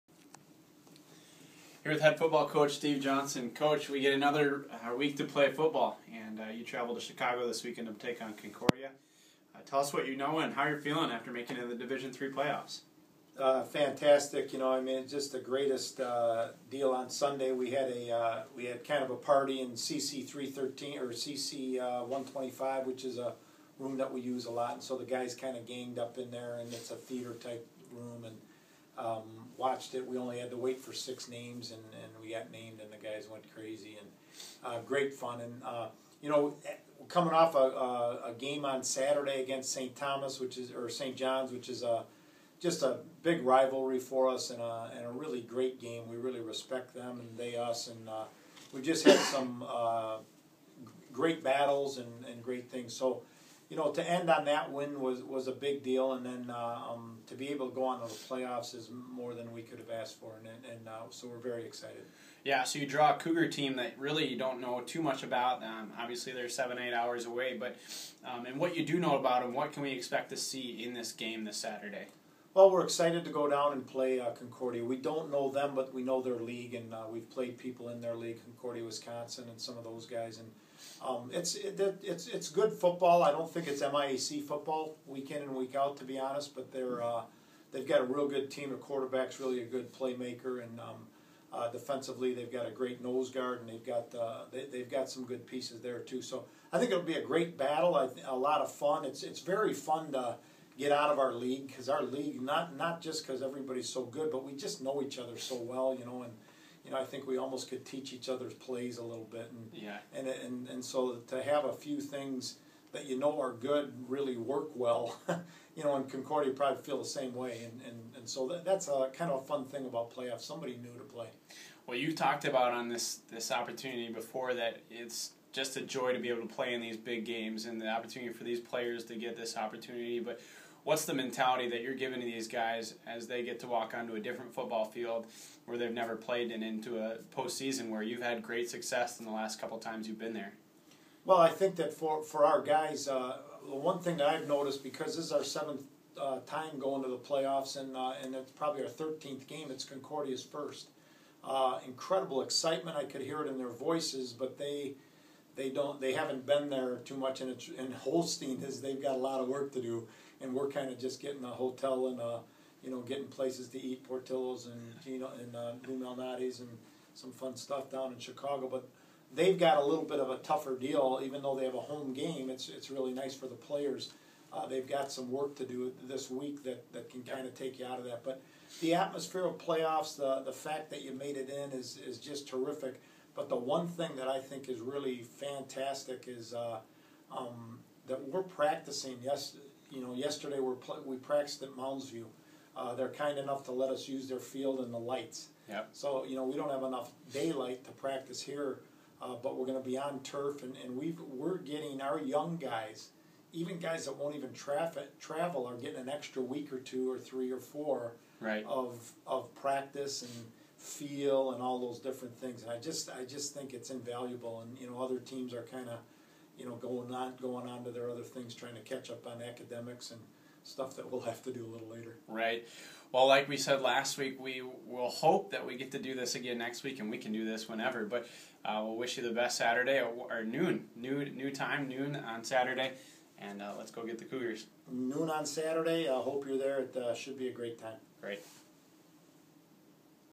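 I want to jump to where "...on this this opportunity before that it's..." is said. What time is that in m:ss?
2:02.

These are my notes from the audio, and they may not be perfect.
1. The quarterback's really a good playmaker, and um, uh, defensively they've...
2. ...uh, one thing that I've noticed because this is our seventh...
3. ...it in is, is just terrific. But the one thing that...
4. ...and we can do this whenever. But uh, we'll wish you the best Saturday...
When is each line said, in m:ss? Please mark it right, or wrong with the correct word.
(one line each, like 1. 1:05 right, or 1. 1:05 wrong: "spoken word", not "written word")
1. 1:28 right
2. 2:23 right
3. 3:01 right
4. 3:46 right.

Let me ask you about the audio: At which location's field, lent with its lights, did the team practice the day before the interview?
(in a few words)
Mounds View.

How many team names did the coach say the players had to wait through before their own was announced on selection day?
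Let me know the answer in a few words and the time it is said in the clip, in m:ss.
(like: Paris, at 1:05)
6, at 0:30.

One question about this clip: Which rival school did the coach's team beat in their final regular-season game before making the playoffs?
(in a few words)
St. John's.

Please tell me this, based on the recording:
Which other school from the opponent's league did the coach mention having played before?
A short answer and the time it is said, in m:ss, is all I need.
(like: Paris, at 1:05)
Concordia, Wisconsin, at 1:18.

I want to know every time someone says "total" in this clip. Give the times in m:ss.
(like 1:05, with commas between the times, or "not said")
not said.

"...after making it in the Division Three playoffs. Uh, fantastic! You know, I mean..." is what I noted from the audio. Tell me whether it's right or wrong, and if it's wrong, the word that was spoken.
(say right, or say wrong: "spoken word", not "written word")
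right.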